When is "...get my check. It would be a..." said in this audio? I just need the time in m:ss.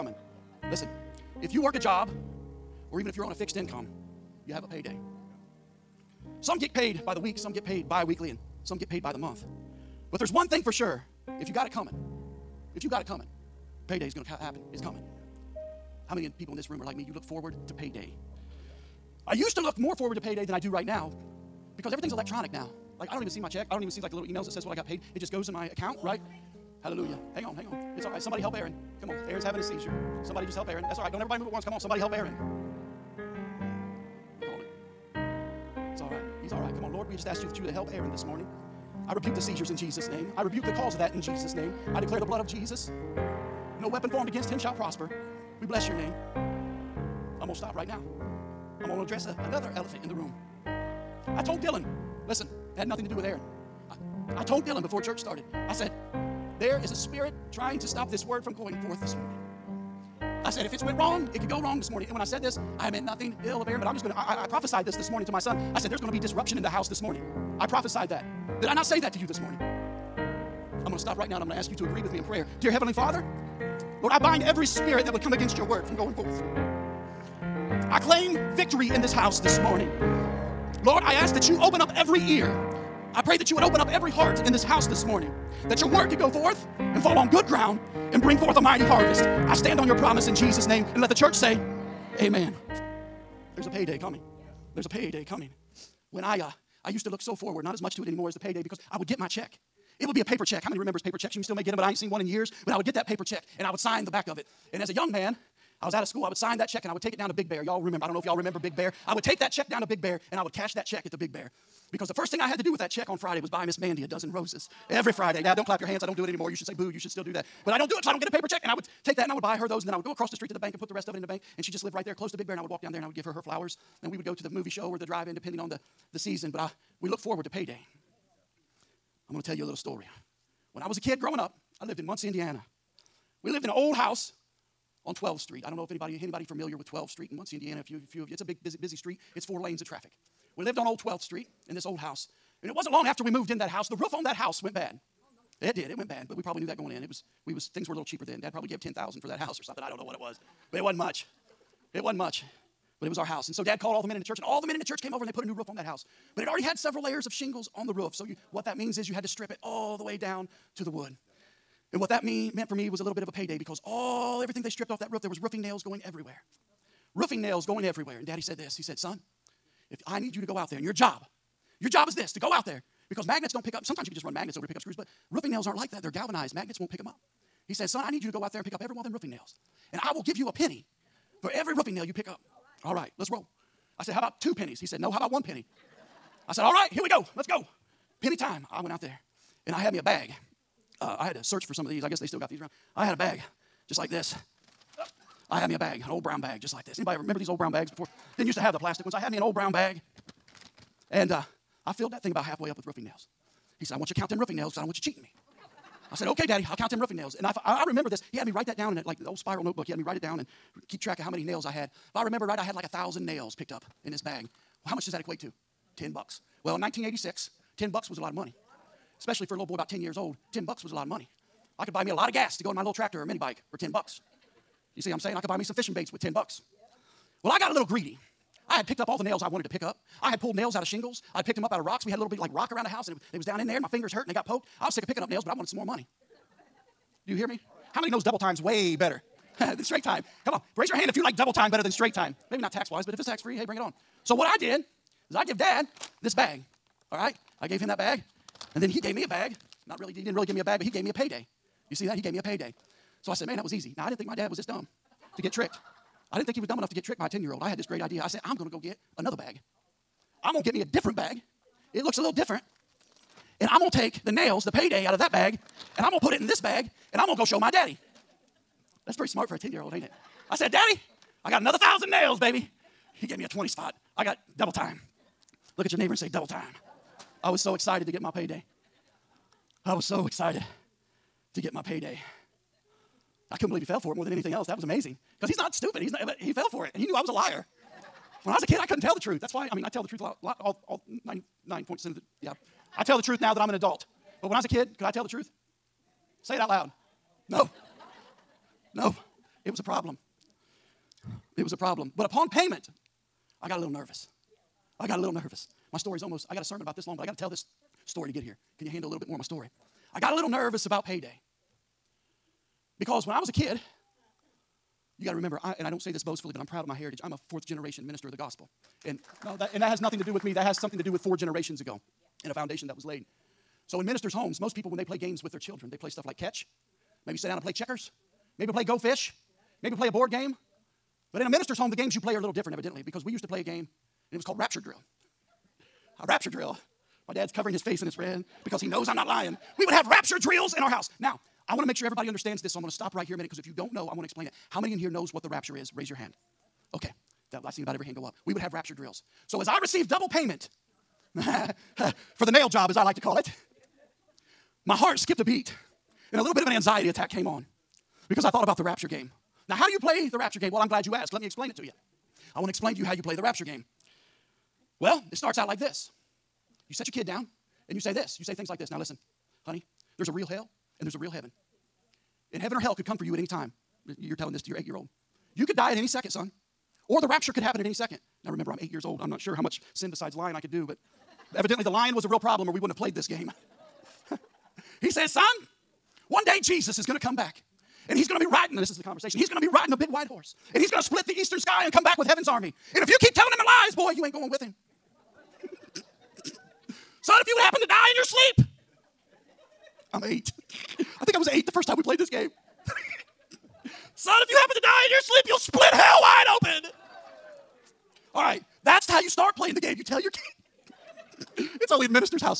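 1:39.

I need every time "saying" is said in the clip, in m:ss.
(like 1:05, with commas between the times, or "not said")
3:45.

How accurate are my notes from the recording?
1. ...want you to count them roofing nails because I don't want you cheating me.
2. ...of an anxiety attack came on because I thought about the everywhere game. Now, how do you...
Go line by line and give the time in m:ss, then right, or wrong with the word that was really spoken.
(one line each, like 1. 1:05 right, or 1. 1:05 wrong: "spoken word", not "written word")
1. 3:23 right
2. 5:56 wrong: "rapture", not "everywhere".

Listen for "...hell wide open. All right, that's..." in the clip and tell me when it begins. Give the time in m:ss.
6:45.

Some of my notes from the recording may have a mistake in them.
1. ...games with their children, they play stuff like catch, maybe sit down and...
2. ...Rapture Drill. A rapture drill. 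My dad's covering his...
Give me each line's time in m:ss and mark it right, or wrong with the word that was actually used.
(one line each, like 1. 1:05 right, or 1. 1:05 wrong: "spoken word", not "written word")
1. 5:25 right
2. 5:34 right.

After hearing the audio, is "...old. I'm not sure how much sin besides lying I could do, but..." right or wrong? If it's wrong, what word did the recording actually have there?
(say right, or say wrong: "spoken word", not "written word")
right.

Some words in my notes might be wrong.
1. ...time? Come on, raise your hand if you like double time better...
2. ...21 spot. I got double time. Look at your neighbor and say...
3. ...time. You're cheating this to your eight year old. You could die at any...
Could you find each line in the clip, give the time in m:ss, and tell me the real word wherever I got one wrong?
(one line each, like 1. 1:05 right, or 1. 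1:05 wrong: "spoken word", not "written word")
1. 4:00 right
2. 4:33 wrong: "20", not "21"
3. 6:13 wrong: "telling", not "cheating".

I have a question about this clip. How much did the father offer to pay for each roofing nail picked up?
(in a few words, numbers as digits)
A penny.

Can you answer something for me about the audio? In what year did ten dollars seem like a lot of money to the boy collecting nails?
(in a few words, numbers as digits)
1986.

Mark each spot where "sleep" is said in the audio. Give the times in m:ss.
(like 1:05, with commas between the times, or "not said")
6:38, 6:45.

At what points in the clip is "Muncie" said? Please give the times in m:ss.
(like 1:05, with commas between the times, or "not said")
2:12, 2:17.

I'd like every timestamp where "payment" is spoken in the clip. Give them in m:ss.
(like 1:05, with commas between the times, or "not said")
5:02, 5:50.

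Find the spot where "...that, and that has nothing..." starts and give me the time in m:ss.
5:19.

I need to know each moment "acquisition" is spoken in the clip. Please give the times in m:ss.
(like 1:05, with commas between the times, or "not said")
not said.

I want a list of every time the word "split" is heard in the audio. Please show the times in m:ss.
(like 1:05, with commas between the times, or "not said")
6:31, 6:45.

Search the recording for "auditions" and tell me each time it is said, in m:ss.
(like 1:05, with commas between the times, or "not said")
not said.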